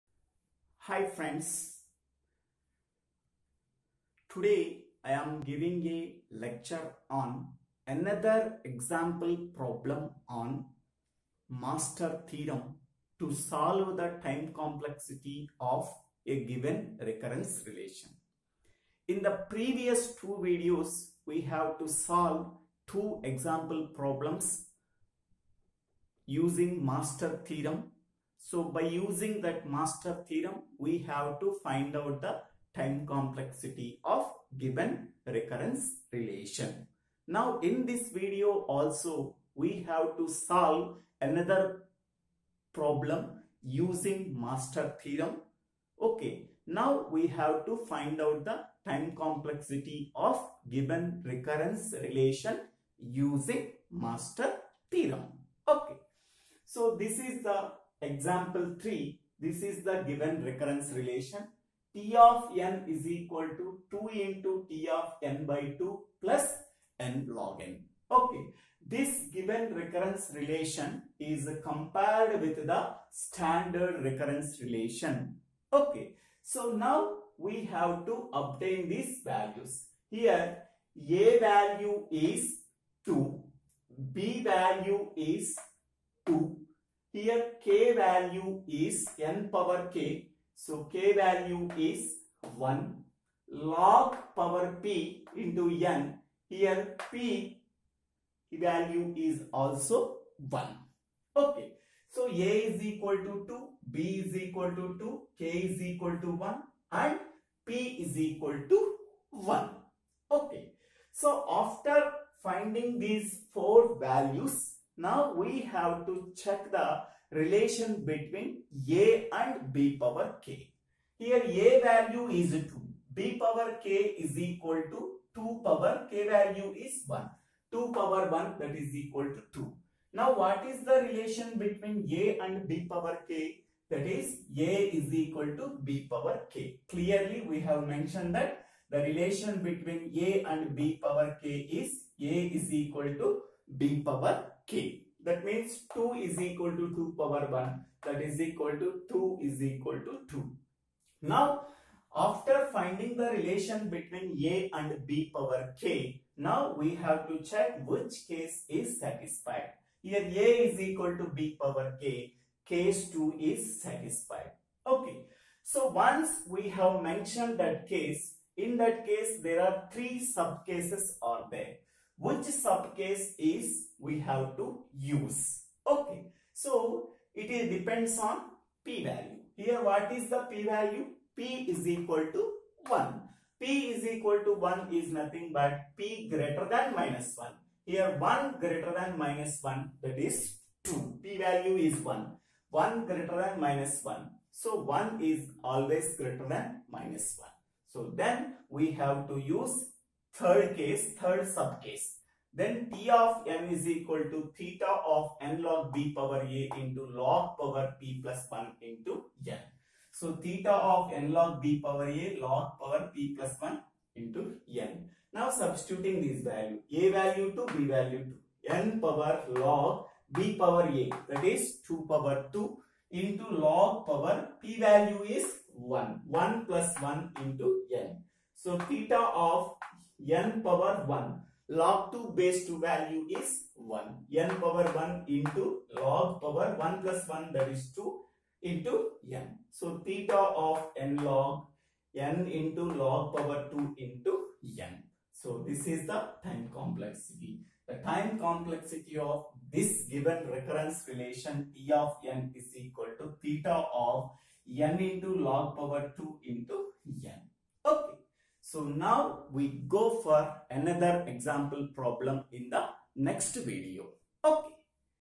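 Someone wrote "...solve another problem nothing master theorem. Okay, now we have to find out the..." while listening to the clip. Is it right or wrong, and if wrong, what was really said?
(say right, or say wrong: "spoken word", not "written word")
wrong: "using", not "nothing".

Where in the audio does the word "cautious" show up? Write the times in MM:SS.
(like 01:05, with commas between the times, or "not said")
not said.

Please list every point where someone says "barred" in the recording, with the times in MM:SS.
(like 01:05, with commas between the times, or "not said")
not said.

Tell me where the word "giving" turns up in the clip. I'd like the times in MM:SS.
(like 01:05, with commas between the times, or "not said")
00:05.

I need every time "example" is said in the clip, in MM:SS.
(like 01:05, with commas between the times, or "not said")
00:08, 00:23, 00:58, 04:21.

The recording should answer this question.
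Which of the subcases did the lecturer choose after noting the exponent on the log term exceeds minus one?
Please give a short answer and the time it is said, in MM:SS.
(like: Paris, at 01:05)
Third subcase, at 03:21.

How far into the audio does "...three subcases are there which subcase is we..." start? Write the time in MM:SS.
02:49.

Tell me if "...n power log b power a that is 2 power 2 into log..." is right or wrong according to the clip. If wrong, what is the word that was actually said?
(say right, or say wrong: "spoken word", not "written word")
right.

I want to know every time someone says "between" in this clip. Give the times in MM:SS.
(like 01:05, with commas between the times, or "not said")
01:58, 02:11, 02:19, 02:33.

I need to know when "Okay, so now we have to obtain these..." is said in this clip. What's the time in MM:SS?
01:15.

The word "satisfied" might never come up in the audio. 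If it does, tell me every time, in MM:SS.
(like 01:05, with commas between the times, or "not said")
02:38, 02:43.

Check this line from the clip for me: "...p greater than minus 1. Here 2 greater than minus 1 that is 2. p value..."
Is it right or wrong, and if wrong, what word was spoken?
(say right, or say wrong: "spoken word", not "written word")
wrong: "1", not "2".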